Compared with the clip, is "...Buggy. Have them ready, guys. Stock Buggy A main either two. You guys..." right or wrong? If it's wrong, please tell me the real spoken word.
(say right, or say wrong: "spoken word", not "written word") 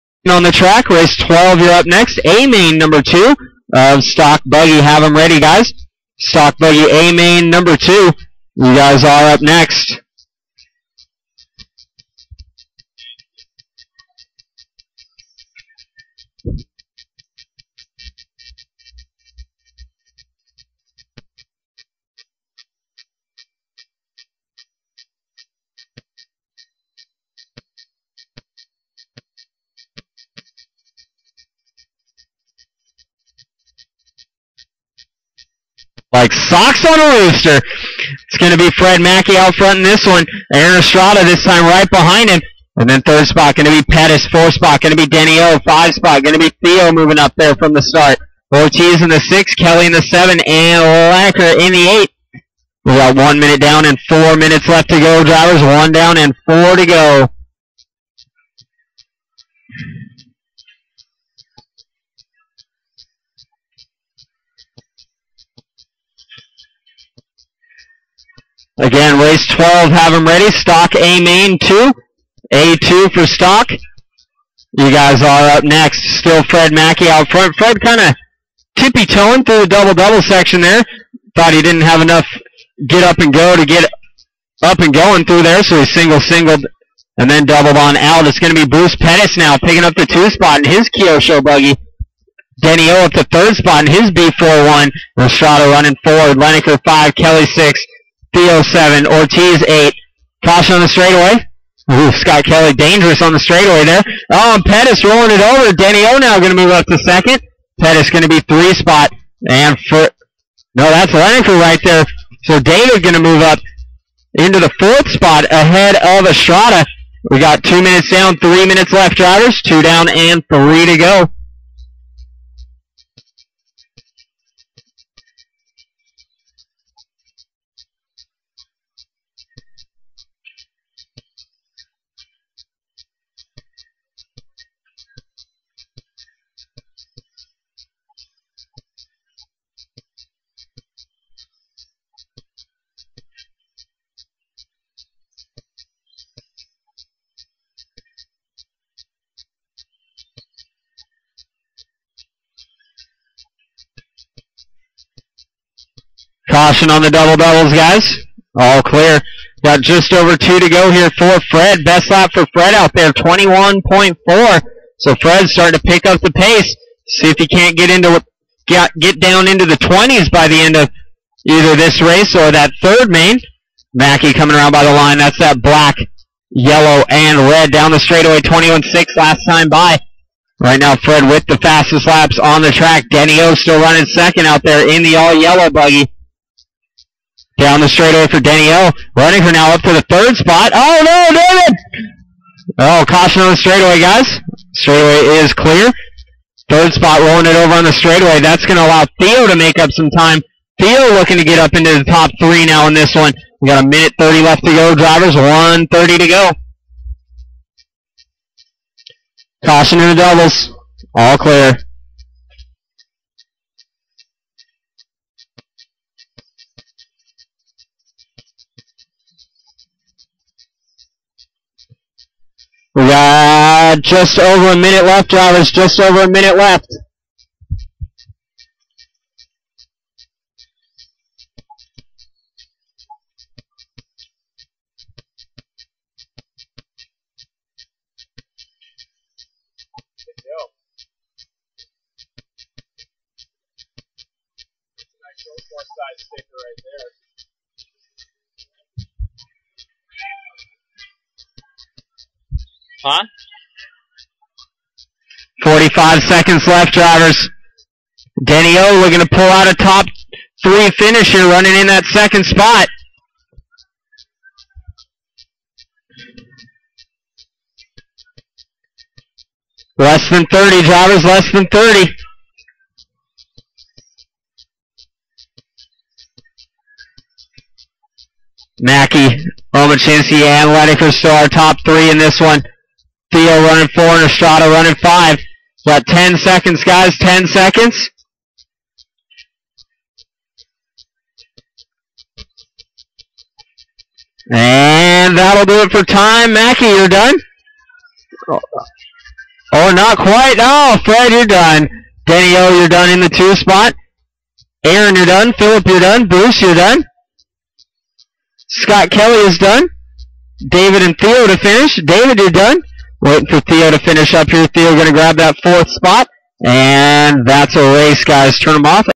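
wrong: "number", not "either".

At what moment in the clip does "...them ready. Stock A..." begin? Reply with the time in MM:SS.
01:10.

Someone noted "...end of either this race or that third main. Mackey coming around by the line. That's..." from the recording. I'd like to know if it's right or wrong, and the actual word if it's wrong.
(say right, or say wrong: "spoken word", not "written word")
right.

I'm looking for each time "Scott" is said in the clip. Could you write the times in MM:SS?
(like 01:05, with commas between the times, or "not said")
01:42, 05:08.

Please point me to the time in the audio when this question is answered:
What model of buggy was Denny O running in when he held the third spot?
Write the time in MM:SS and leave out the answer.
01:34.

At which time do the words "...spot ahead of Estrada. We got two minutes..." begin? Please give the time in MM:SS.
01:55.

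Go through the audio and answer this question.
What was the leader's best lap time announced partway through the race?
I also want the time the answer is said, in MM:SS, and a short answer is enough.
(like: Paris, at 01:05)
21.4, at 02:43.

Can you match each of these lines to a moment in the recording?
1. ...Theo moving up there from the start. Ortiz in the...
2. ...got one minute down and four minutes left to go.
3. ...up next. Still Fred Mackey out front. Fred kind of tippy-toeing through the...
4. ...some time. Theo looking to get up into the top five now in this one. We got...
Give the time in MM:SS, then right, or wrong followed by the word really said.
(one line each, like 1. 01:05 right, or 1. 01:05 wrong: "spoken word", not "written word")
1. 00:46 right
2. 00:52 right
3. 01:15 right
4. 03:19 wrong: "three", not "five".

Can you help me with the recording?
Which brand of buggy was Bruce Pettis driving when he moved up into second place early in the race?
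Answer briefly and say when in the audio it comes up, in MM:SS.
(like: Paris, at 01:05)
Kyosho, at 01:30.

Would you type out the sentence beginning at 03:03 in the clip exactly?
Denny O still running second out there in the all yellow buggy.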